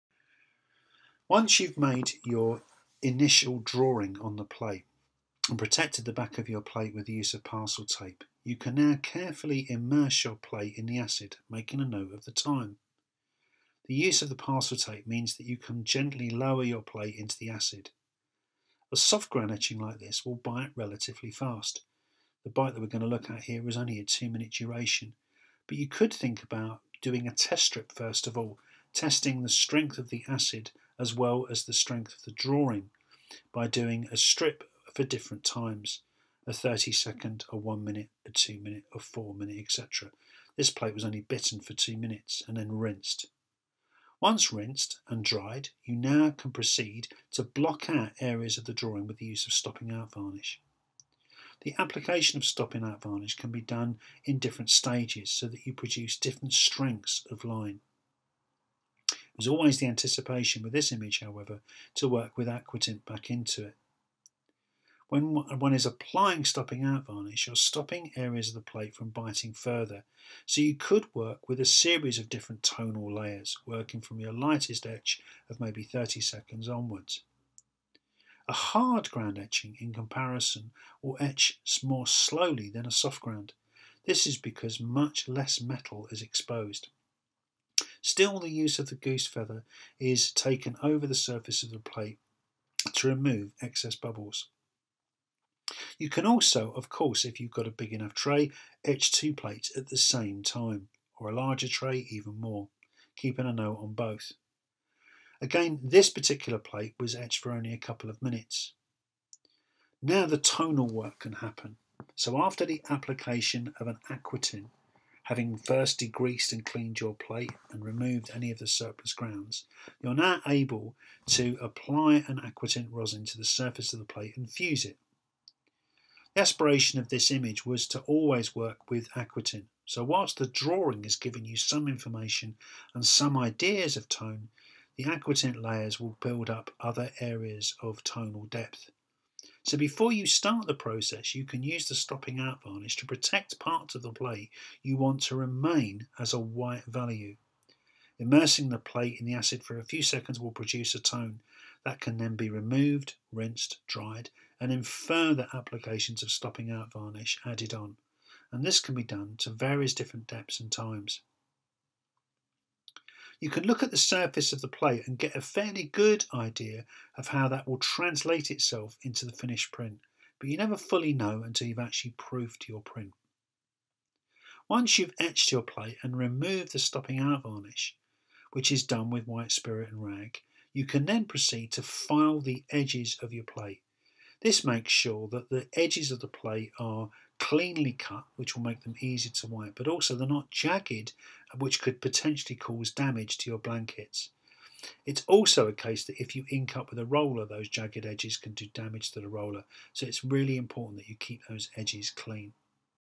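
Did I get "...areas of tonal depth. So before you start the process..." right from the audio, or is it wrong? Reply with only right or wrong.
right.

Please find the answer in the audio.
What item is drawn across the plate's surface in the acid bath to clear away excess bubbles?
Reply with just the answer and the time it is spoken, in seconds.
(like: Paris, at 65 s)
Goose feather, at 88 s.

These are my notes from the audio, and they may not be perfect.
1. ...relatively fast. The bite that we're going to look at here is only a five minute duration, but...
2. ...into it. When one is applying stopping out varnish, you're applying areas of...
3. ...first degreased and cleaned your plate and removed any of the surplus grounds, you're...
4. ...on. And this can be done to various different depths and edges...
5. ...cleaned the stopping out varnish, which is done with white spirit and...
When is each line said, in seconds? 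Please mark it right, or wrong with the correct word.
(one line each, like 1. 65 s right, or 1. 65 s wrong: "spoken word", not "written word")
1. 20 s wrong: "two", not "five"
2. 63 s wrong: "stopping", not "applying"
3. 115 s right
4. 157 s wrong: "times", not "edges"
5. 176 s wrong: "removed", not "cleaned".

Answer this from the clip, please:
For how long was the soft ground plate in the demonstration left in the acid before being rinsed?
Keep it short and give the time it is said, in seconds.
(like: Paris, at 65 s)
2 minutes, at 41 s.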